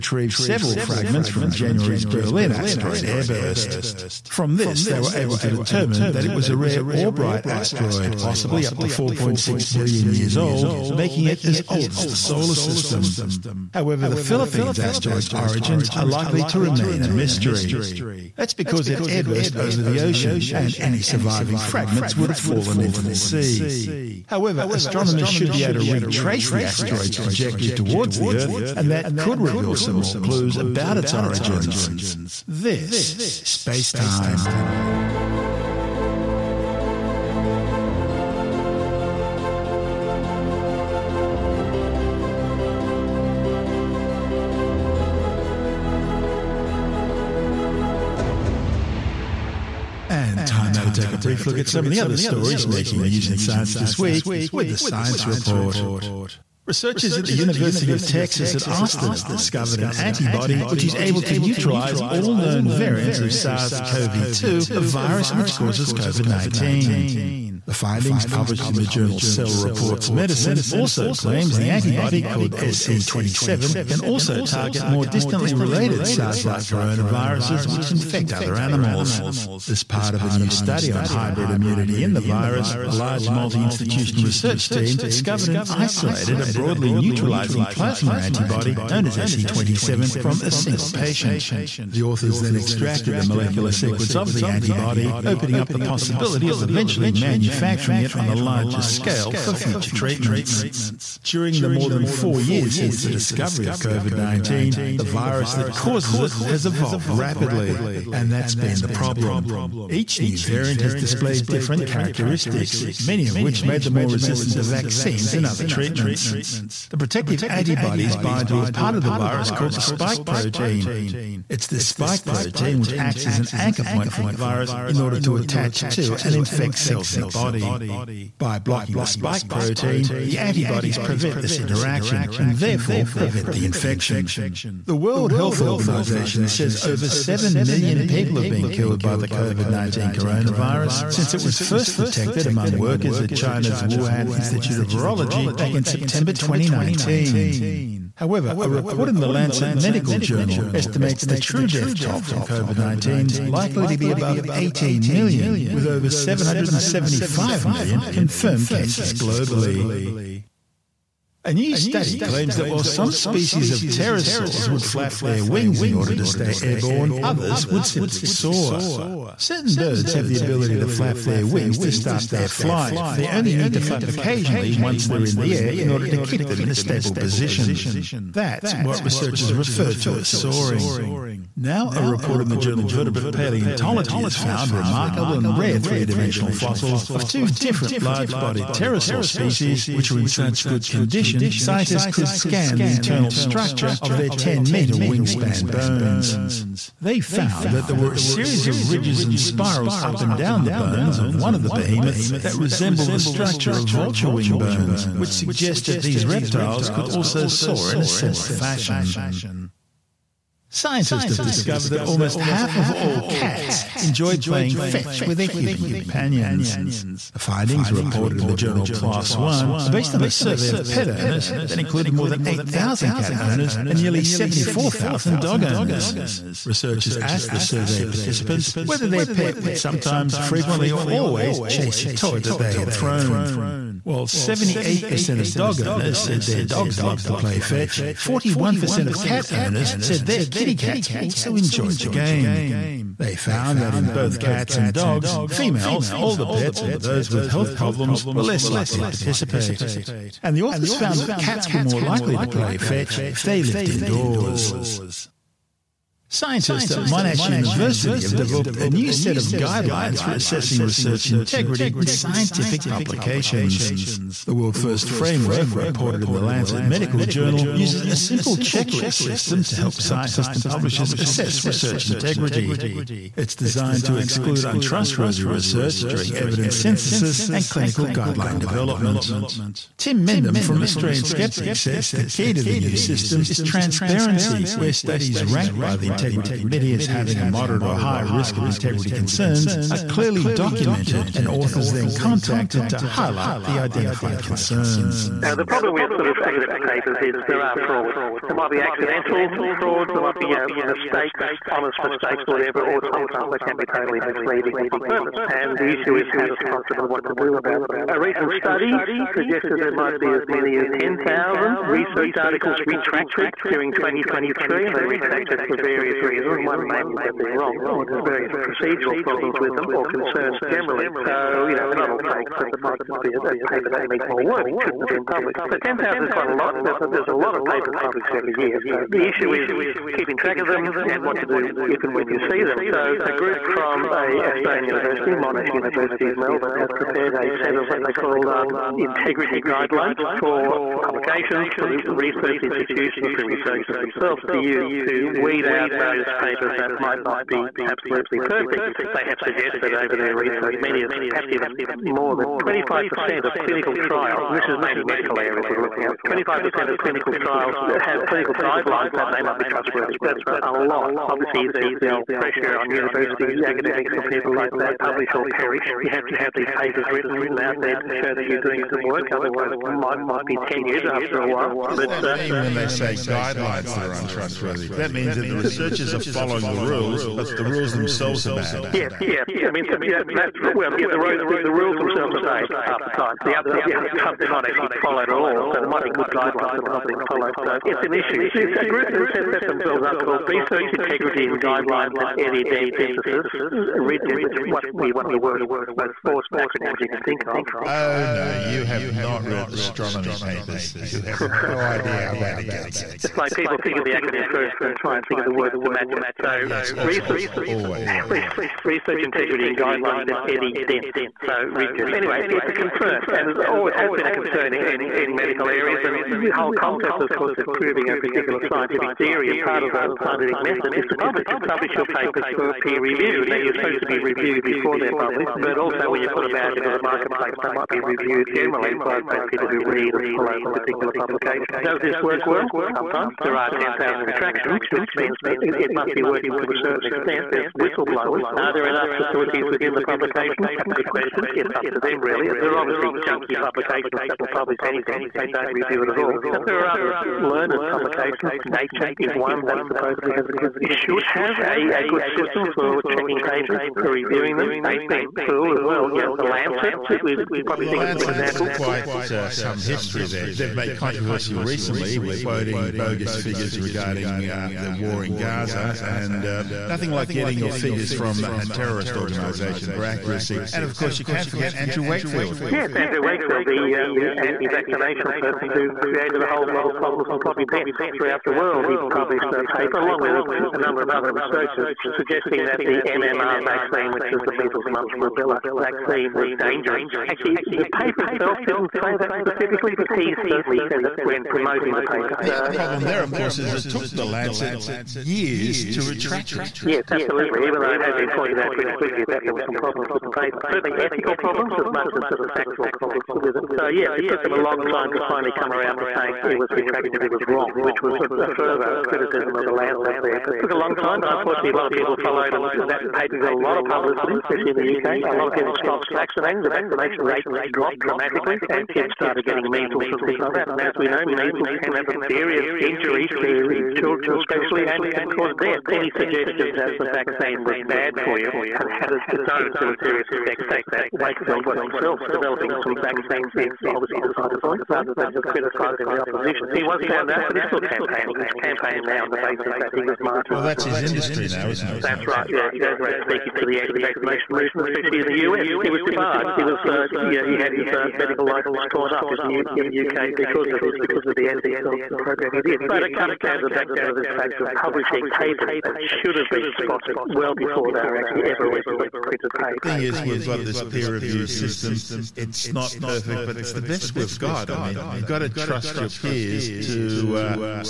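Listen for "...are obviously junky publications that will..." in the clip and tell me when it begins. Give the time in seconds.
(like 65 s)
442 s.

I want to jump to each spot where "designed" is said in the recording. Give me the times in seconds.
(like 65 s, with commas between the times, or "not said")
273 s.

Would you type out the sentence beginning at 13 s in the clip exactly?
However, the Philippines asteroid's origins are likely to remain a mystery.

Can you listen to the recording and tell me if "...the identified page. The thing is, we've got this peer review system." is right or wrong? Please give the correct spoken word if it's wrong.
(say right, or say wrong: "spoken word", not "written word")
wrong: "printed", not "identified".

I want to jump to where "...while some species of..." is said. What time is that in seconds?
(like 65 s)
162 s.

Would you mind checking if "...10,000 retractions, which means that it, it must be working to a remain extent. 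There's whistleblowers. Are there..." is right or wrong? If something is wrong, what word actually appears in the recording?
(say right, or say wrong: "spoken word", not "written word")
wrong: "certain", not "remain".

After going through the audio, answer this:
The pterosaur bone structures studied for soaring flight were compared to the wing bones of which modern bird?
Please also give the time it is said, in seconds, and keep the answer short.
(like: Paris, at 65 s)
vulture, at 203 s.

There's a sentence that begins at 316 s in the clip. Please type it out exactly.
One mainly that they're wrong, or there's various procedural problems with them, or concerns generally.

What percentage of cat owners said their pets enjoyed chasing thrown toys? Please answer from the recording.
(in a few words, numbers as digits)
41%.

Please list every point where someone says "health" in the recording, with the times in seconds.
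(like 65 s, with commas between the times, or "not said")
135 s, 247 s.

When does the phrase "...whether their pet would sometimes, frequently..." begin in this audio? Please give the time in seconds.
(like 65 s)
228 s.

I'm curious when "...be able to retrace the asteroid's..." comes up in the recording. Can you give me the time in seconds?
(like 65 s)
25 s.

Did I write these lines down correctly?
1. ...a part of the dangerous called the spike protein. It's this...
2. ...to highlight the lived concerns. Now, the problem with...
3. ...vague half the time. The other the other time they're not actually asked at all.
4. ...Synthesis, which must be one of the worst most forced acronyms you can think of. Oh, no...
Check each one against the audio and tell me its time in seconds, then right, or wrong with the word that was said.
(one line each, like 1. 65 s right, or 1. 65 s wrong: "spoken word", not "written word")
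1. 118 s wrong: "virus", not "dangerous"
2. 292 s wrong: "identified", not "lived"
3. 382 s wrong: "followed", not "asked"
4. 392 s right.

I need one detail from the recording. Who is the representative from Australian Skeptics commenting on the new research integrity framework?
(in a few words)
Tim Mendham.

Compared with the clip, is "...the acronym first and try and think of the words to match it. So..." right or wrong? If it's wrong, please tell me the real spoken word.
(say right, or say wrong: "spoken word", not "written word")
right.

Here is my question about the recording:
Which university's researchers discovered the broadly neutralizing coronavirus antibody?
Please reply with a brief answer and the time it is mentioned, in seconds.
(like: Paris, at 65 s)
University of Texas at Austin, at 57 s.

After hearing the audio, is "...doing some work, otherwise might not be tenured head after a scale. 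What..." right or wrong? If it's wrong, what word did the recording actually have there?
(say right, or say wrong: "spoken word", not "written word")
wrong: "while", not "scale".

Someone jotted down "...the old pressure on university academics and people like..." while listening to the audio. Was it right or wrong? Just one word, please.
right.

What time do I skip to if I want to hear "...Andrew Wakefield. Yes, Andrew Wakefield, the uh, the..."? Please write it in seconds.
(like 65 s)
471 s.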